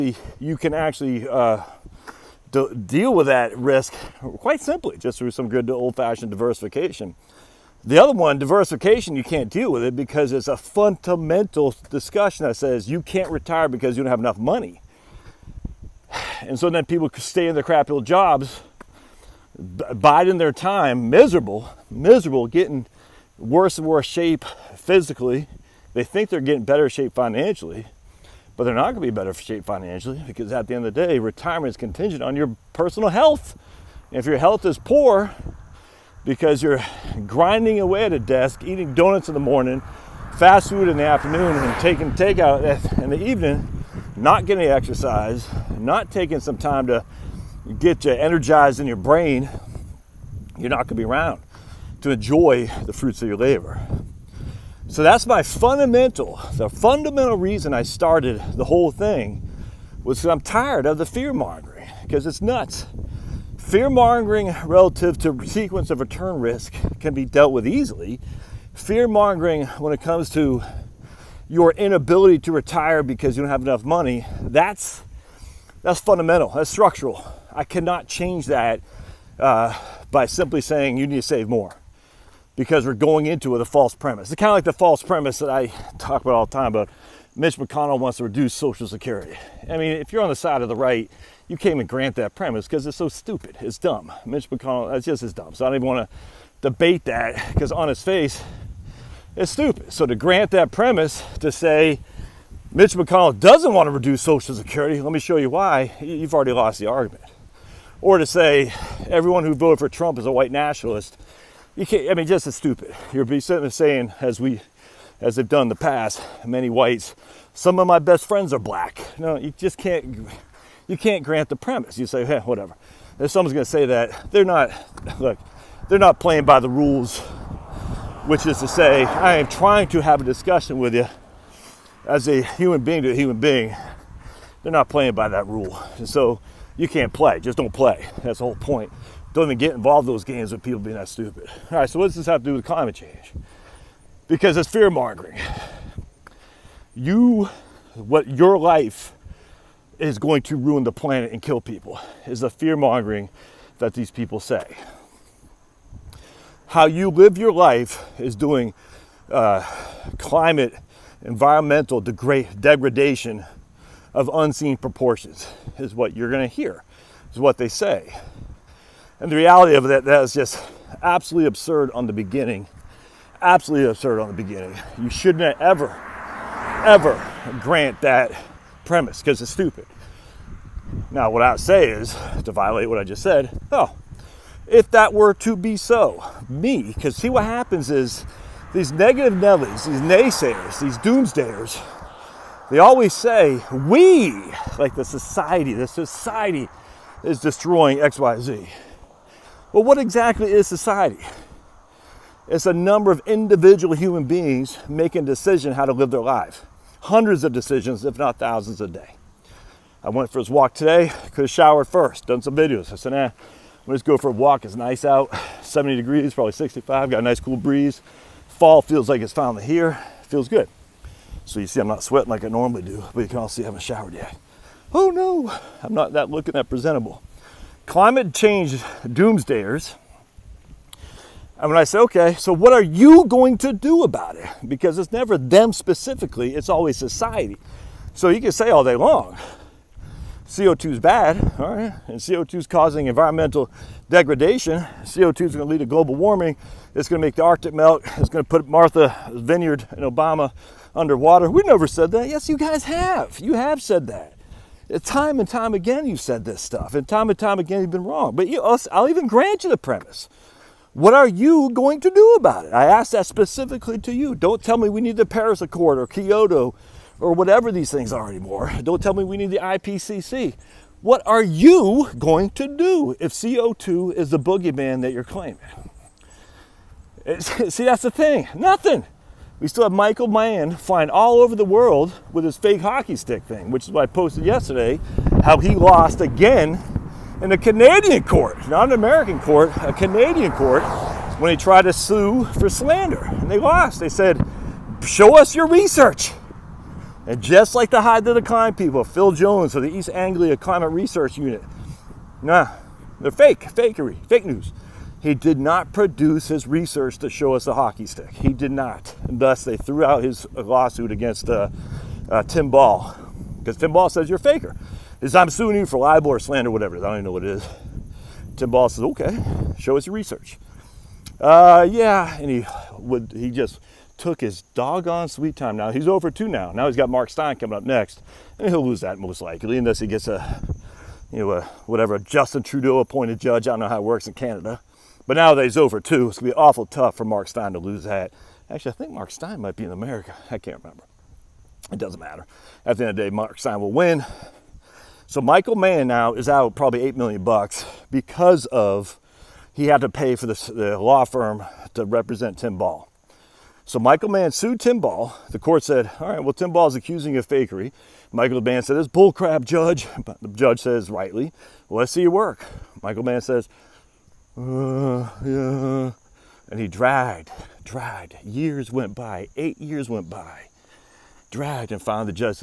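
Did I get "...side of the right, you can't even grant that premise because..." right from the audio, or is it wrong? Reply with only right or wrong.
right.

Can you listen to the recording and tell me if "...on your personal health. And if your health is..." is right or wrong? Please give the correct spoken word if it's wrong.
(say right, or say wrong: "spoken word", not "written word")
right.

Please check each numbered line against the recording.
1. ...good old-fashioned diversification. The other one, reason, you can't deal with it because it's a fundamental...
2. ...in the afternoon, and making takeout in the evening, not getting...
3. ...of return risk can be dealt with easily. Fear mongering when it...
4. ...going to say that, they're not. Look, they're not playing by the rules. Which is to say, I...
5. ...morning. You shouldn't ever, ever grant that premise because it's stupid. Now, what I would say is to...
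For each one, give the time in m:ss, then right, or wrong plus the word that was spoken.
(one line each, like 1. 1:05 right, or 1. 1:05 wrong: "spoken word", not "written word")
1. 0:05 wrong: "diversification", not "reason"
2. 0:40 wrong: "taking", not "making"
3. 1:05 right
4. 2:03 right
5. 2:54 wrong: "beginning", not "morning".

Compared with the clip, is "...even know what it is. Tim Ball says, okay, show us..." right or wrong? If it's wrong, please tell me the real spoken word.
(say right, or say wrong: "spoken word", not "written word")
right.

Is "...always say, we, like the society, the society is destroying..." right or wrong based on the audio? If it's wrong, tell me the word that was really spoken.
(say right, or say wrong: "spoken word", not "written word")
right.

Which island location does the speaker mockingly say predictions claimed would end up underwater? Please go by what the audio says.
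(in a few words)
Martha's Vineyard.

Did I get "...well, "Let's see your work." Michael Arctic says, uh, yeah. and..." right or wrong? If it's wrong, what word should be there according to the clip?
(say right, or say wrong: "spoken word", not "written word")
wrong: "Mann", not "Arctic".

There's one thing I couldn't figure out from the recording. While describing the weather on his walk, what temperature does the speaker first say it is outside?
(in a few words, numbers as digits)
70 degrees.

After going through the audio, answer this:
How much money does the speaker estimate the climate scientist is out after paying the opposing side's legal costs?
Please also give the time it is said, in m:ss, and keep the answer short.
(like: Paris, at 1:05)
$8 million, at 5:47.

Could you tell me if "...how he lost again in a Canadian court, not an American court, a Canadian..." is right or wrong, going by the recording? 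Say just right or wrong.
right.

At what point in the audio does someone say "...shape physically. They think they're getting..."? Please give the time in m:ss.
0:24.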